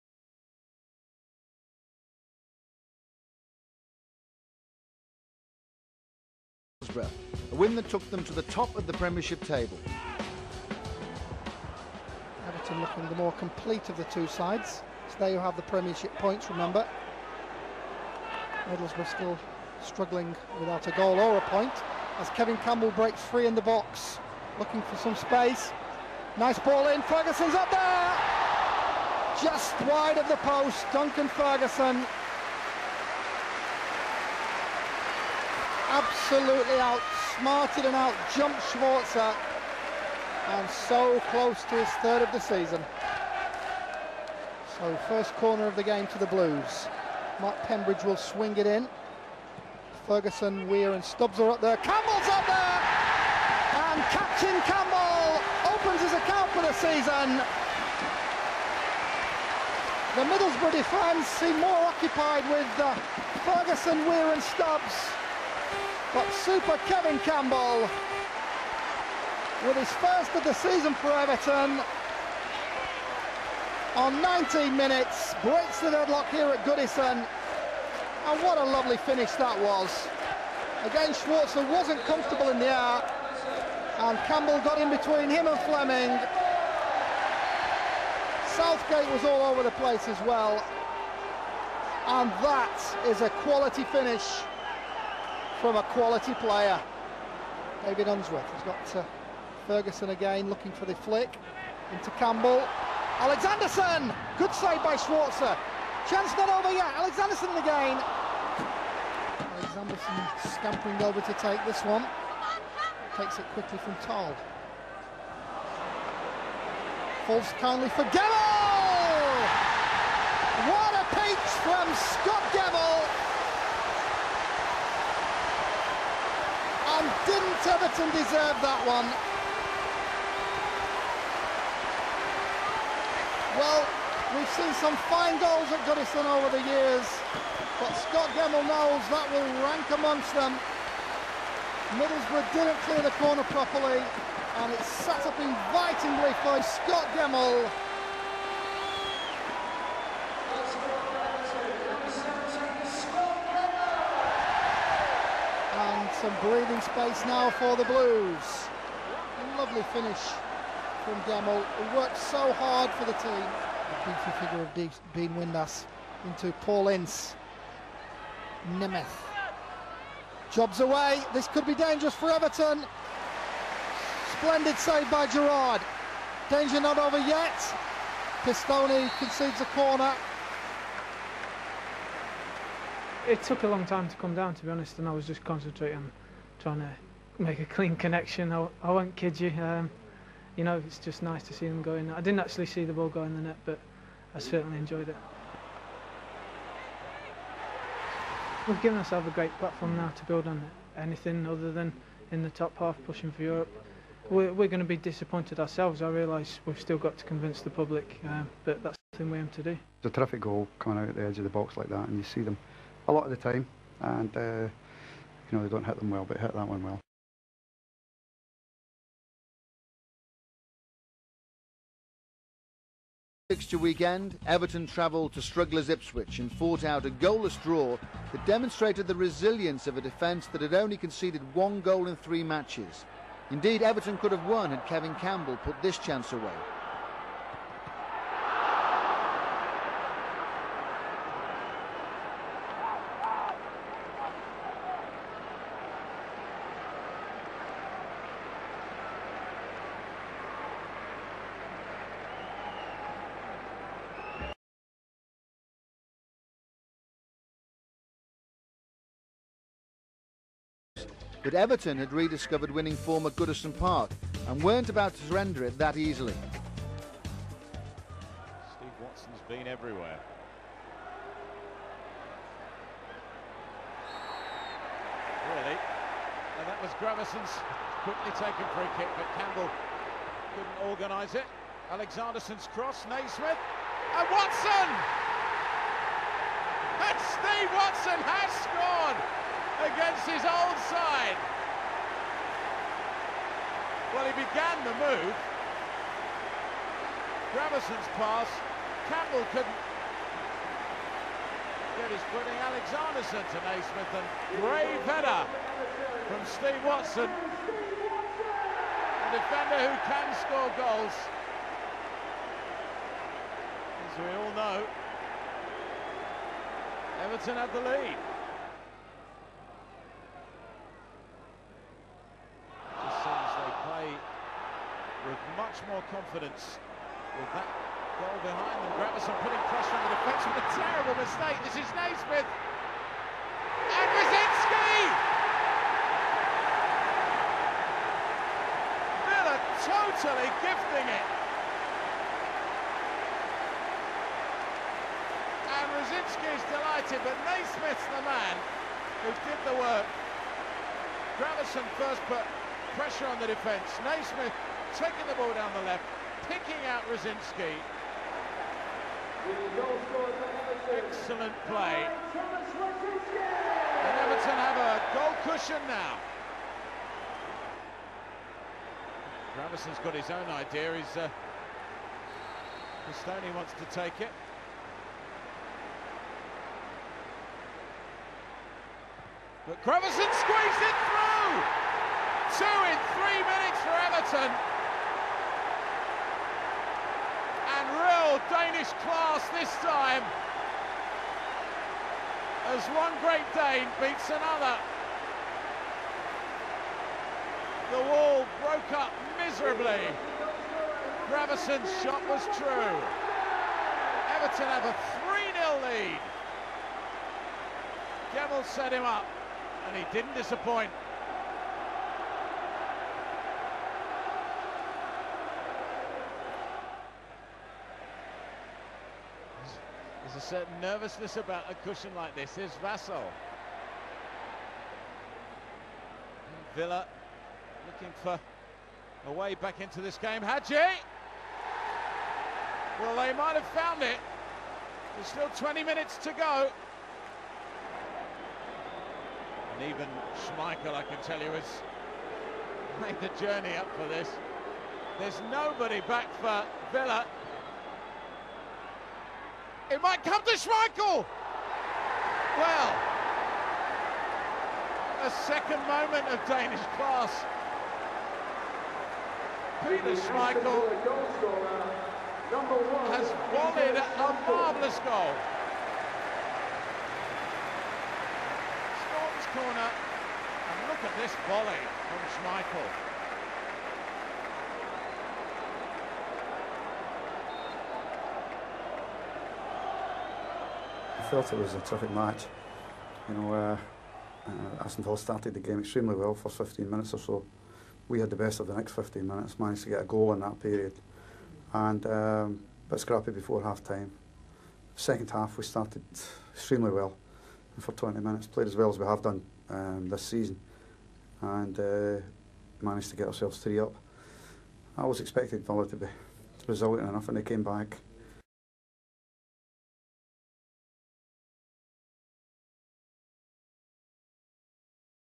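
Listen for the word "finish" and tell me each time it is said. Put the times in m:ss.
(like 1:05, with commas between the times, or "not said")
1:18, 1:33, 2:39.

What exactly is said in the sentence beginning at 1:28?
Southgate was all over the place as well.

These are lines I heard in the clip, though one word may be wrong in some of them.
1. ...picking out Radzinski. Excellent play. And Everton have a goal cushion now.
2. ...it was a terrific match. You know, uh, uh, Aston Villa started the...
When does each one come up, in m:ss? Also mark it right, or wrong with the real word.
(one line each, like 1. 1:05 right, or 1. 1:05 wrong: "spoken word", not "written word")
1. 5:56 right
2. 8:01 right.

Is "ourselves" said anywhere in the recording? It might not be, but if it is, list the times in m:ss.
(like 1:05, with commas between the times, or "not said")
3:18, 3:25, 8:23.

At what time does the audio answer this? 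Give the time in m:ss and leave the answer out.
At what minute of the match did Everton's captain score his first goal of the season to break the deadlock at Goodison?
1:14.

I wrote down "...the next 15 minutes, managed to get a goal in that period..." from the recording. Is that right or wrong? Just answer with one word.
right.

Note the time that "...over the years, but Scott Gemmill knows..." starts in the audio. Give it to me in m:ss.
2:16.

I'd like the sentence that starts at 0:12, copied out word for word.
Everton looking the more complete of the two sides.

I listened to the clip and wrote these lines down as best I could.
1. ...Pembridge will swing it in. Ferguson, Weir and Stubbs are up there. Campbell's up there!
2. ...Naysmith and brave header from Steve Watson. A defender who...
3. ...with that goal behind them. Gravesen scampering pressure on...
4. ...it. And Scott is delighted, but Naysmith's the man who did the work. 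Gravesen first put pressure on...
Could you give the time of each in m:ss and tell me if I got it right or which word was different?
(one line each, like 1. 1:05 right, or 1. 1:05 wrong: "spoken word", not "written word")
1. 0:47 right
2. 5:03 right
3. 5:27 wrong: "putting", not "scampering"
4. 5:41 wrong: "Radzinski", not "Scott".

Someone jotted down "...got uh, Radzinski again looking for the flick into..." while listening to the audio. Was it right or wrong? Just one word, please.
wrong.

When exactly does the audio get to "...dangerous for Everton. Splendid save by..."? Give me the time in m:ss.
2:51.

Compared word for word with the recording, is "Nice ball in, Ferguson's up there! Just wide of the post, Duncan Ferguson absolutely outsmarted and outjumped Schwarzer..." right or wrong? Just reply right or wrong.
right.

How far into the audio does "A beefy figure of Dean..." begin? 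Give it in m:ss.
2:43.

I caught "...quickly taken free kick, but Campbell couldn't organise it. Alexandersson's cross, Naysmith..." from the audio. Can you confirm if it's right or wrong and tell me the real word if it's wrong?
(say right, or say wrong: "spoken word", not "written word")
right.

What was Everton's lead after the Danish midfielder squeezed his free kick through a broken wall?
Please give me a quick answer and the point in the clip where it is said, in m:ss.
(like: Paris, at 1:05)
3-0, at 6:45.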